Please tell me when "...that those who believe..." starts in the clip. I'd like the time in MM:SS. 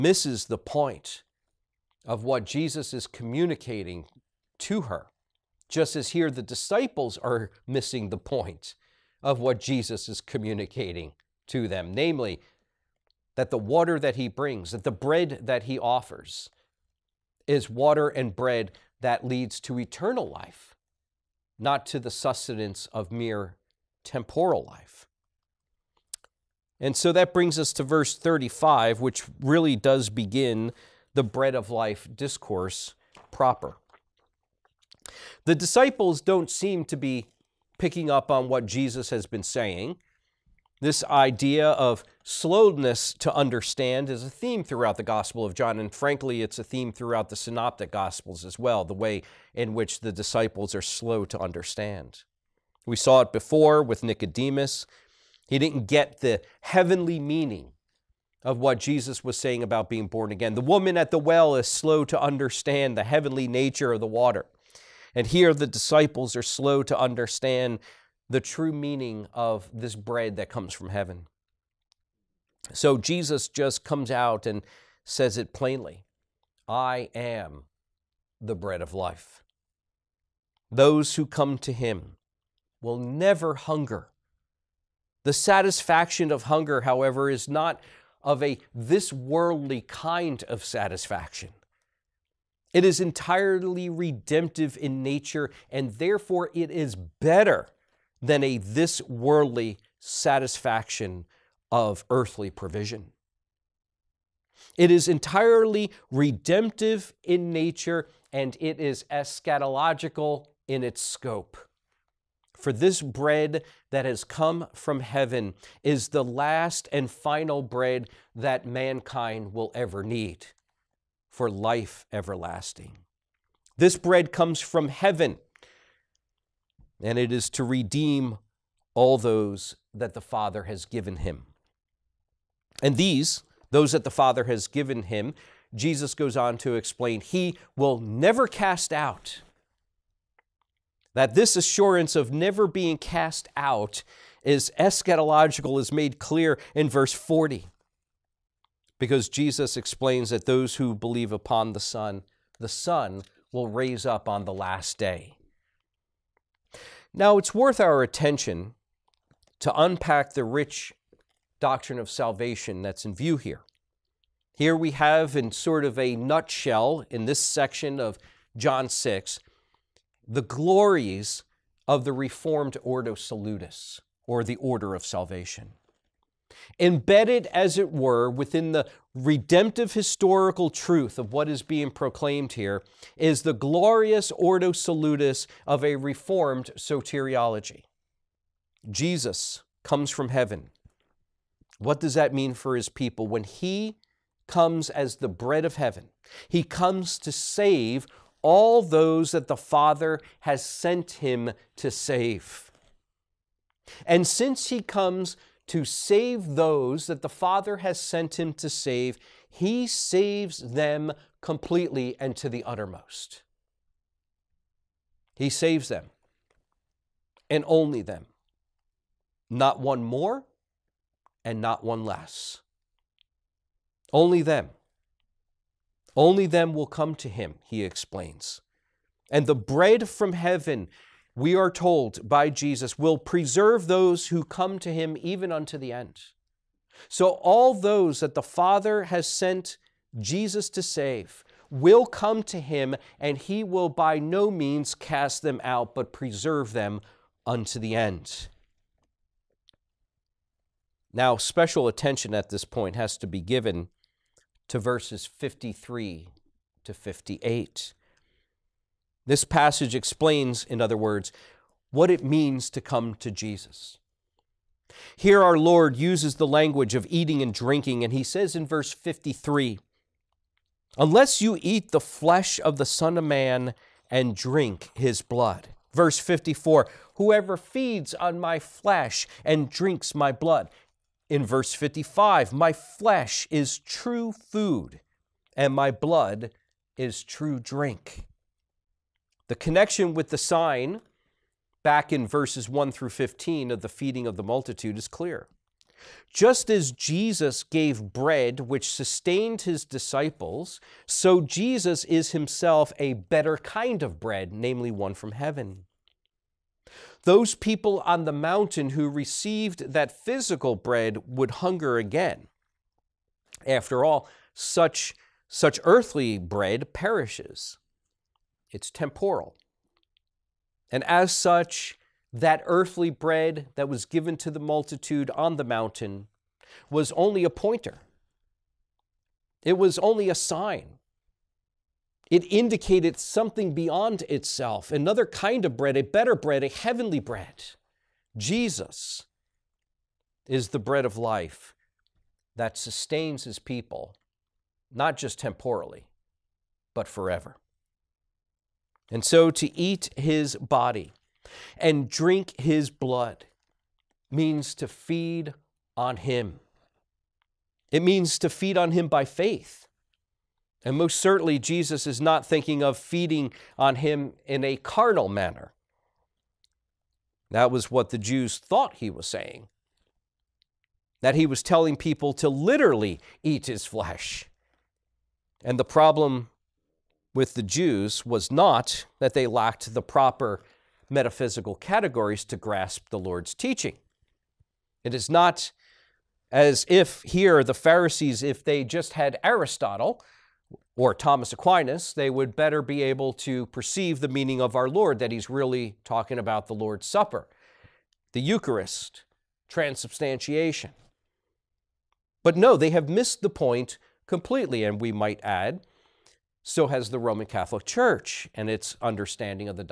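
02:30.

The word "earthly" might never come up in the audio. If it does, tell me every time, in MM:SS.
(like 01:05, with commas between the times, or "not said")
01:42, 05:15, 05:22.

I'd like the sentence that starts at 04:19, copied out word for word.
This passage explains, in other words, what it means to come to Jesus.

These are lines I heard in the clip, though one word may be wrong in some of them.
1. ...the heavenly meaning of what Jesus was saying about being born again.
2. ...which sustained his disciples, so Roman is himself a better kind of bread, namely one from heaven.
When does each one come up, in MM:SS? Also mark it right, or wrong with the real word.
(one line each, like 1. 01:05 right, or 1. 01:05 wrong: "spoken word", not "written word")
1. 00:56 right
2. 04:58 wrong: "Jesus", not "Roman".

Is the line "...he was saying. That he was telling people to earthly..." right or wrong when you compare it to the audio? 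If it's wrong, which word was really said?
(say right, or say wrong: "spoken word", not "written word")
wrong: "literally", not "earthly".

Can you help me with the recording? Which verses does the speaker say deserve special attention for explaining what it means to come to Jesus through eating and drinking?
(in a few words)
Verses 53 to 58.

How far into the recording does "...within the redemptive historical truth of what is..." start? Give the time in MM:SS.
02:58.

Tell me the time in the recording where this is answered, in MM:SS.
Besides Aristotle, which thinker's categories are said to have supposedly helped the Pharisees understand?
06:31.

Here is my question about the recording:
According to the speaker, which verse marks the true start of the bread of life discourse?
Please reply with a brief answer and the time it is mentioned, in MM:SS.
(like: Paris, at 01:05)
Verse 35, at 00:27.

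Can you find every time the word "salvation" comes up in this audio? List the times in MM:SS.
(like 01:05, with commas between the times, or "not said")
02:42, 02:55.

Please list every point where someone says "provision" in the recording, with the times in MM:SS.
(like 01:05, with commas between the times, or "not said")
01:42.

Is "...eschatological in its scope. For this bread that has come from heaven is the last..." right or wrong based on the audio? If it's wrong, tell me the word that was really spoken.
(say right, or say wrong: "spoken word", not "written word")
right.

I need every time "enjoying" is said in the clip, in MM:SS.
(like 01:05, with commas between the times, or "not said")
not said.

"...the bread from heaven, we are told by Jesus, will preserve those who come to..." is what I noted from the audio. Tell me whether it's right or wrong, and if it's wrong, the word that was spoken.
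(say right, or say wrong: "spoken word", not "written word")
right.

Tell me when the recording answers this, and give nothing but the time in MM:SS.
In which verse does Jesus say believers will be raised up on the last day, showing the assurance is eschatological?
02:26.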